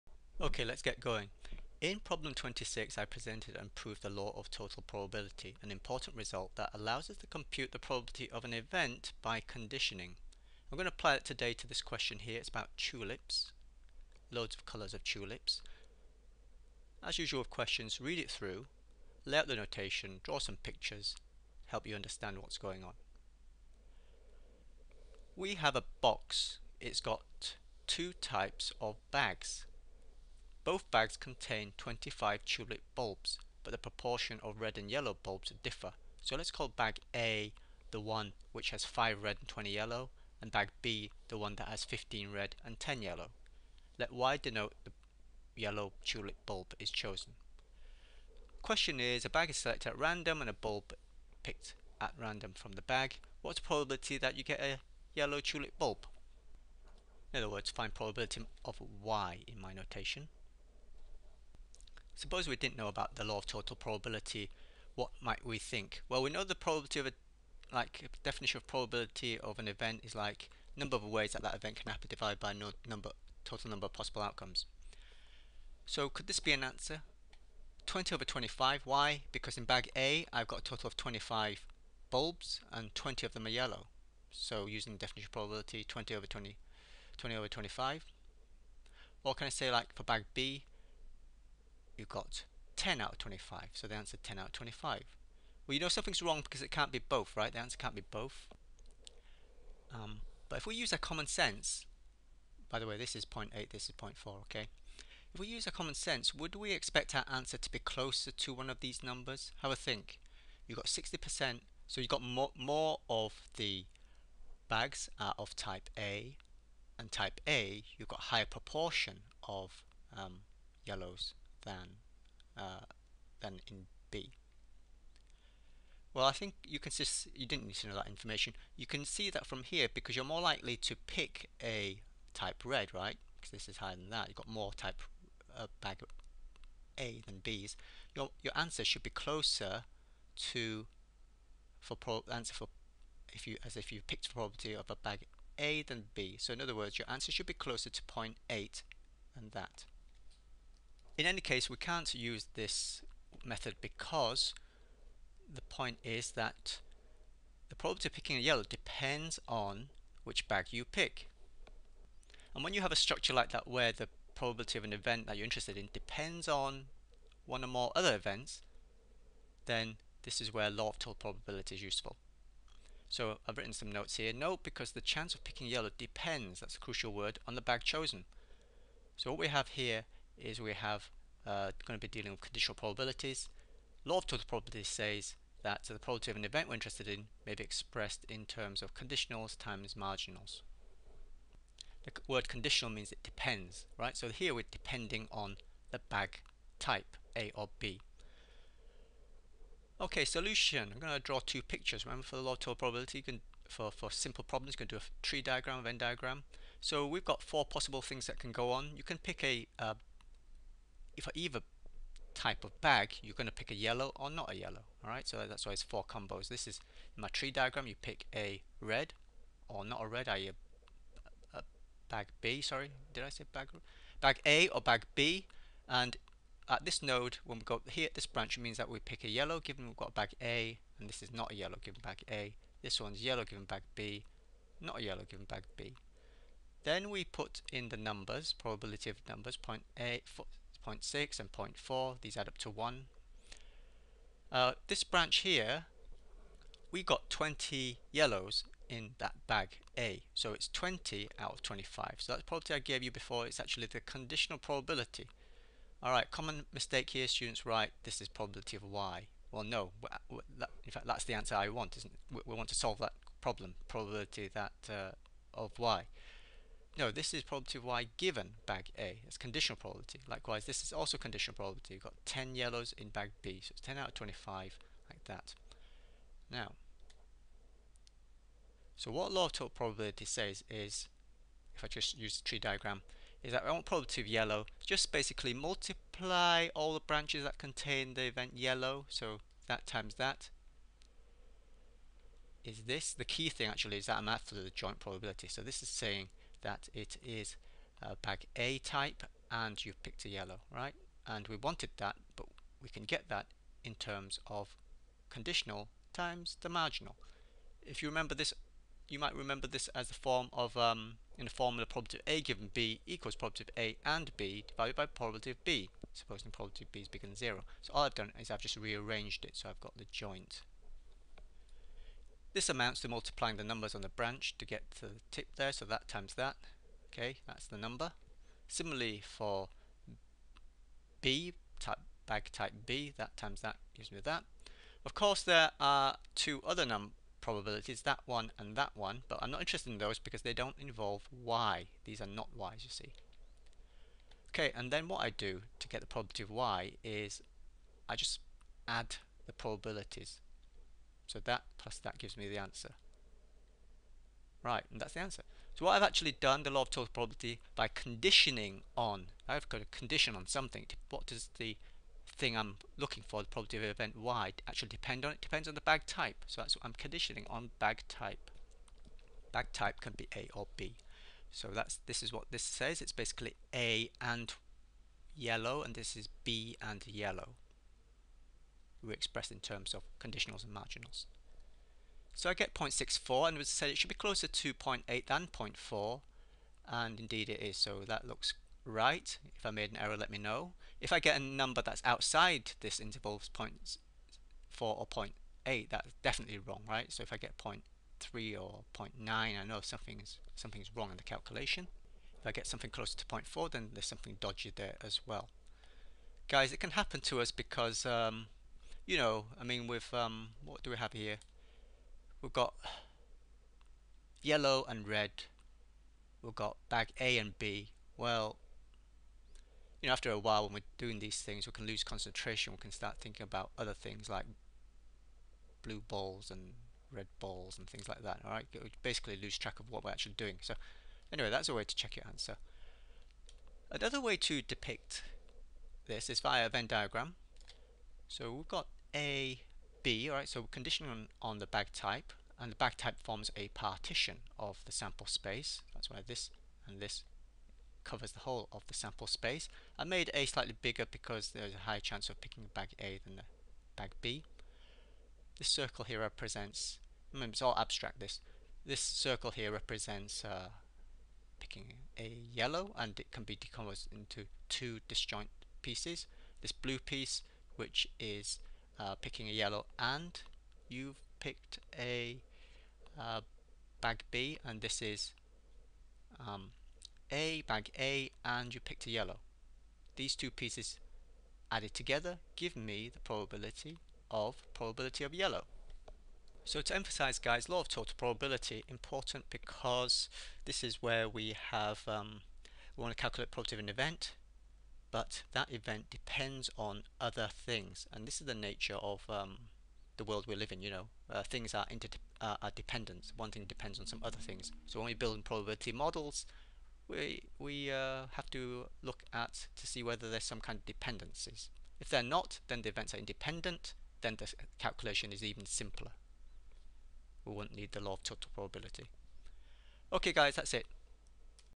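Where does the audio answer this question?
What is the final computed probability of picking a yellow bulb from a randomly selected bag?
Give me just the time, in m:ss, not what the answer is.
6:22.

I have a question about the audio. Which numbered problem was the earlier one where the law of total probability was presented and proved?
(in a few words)
26.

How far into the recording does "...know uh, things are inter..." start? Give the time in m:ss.
8:20.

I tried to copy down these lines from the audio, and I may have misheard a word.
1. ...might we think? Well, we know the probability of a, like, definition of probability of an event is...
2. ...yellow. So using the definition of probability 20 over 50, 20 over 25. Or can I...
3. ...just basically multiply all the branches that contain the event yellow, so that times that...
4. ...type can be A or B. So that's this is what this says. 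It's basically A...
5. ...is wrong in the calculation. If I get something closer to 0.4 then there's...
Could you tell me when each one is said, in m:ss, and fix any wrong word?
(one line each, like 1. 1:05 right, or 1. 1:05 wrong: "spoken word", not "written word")
1. 1:05 right
2. 1:23 wrong: "20", not "50"
3. 4:44 right
4. 6:09 right
5. 6:40 right.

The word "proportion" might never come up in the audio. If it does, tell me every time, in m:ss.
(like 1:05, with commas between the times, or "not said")
0:33, 1:58.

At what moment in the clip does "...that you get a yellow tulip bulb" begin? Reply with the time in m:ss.
0:54.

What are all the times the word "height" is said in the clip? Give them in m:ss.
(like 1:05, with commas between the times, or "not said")
not said.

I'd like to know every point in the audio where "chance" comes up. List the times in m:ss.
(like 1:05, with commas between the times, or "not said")
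2:55, 7:31.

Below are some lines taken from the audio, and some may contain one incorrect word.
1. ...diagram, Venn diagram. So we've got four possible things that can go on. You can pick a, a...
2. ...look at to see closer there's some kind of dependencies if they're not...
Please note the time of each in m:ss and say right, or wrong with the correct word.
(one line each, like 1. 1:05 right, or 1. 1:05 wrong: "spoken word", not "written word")
1. 3:25 right
2. 8:29 wrong: "whether", not "closer".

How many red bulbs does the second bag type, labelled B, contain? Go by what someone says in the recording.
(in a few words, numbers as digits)
15.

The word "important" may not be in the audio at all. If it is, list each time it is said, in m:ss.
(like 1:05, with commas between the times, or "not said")
0:05, 8:08.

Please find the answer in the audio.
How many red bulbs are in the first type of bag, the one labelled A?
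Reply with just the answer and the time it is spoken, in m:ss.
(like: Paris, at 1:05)
5, at 0:38.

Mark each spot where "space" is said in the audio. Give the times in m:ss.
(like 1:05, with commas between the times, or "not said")
7:25, 7:29.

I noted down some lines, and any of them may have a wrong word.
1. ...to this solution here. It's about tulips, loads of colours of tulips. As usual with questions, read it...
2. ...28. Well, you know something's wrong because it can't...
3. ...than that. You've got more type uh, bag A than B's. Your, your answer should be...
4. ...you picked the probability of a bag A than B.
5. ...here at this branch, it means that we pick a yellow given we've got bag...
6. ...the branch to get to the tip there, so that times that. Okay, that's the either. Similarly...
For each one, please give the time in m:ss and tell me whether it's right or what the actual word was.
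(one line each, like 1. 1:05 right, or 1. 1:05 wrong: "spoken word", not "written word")
1. 0:11 wrong: "question", not "solution"
2. 1:34 wrong: "25", not "28"
3. 2:13 right
4. 2:23 right
5. 3:47 right
6. 5:24 wrong: "number", not "either".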